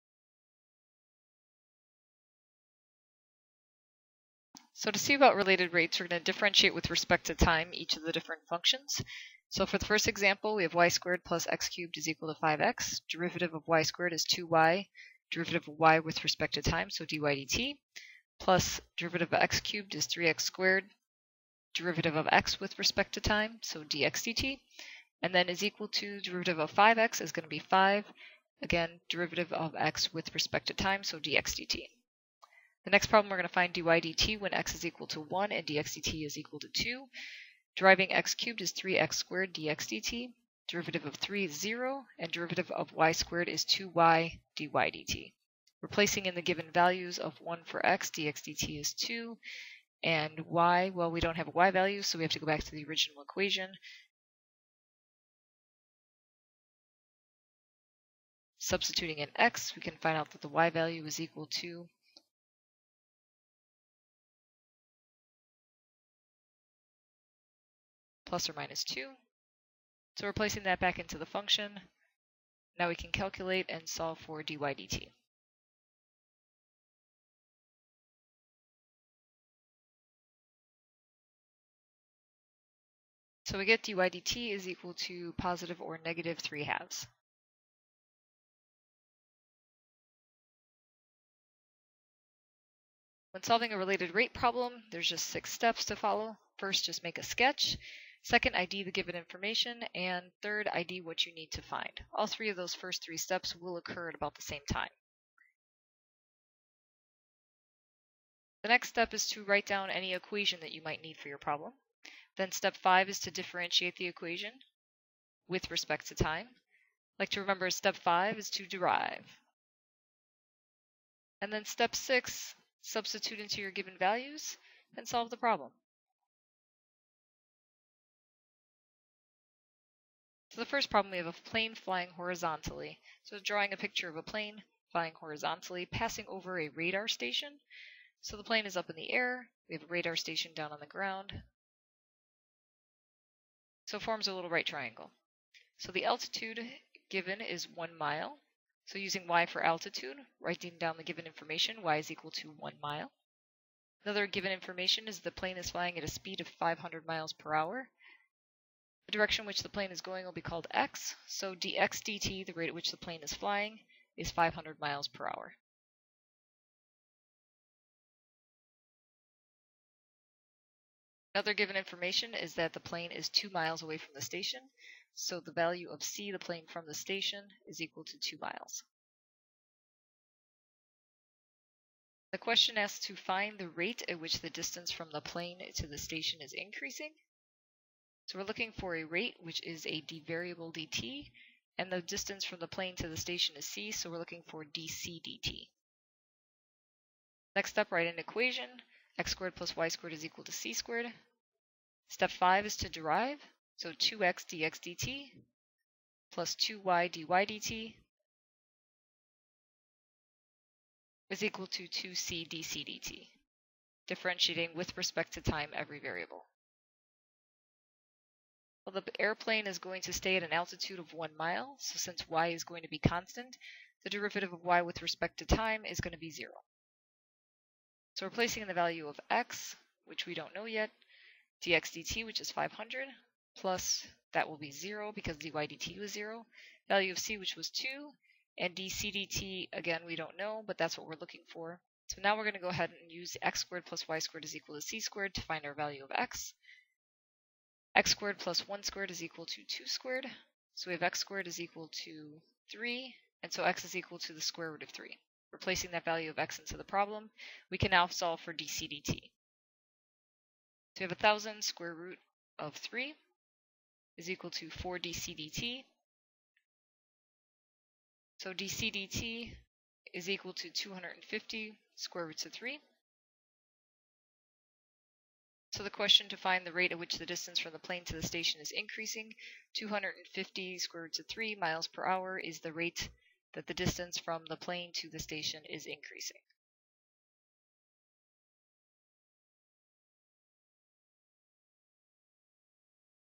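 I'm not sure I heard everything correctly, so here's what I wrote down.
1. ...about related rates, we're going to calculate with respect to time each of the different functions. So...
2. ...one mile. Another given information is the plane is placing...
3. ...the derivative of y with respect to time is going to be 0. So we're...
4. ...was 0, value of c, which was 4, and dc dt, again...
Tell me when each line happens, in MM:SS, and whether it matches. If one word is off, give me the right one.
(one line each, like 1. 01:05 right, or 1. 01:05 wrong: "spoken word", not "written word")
1. 00:05 wrong: "differentiate", not "calculate"
2. 02:32 wrong: "flying", not "placing"
3. 03:44 right
4. 03:55 wrong: "2", not "4".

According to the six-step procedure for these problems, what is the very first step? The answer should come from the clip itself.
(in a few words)
Make a sketch.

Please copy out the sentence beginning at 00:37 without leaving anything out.
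Deriving x cubed is 3x squared dx dt.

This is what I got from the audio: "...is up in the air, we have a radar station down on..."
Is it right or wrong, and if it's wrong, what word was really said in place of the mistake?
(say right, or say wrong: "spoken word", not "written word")
right.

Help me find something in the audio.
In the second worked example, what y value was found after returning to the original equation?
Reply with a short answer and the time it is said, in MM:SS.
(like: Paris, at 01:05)
±2, at 01:08.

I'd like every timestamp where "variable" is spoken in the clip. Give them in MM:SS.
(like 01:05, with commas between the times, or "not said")
03:10, 03:35.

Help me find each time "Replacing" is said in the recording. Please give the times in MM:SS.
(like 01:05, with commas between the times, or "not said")
00:45, 04:15.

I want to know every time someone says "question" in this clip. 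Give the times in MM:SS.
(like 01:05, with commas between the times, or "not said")
03:02, 04:35.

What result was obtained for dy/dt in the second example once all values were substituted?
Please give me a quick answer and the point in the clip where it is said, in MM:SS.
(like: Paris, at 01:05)
±3/2, at 01:25.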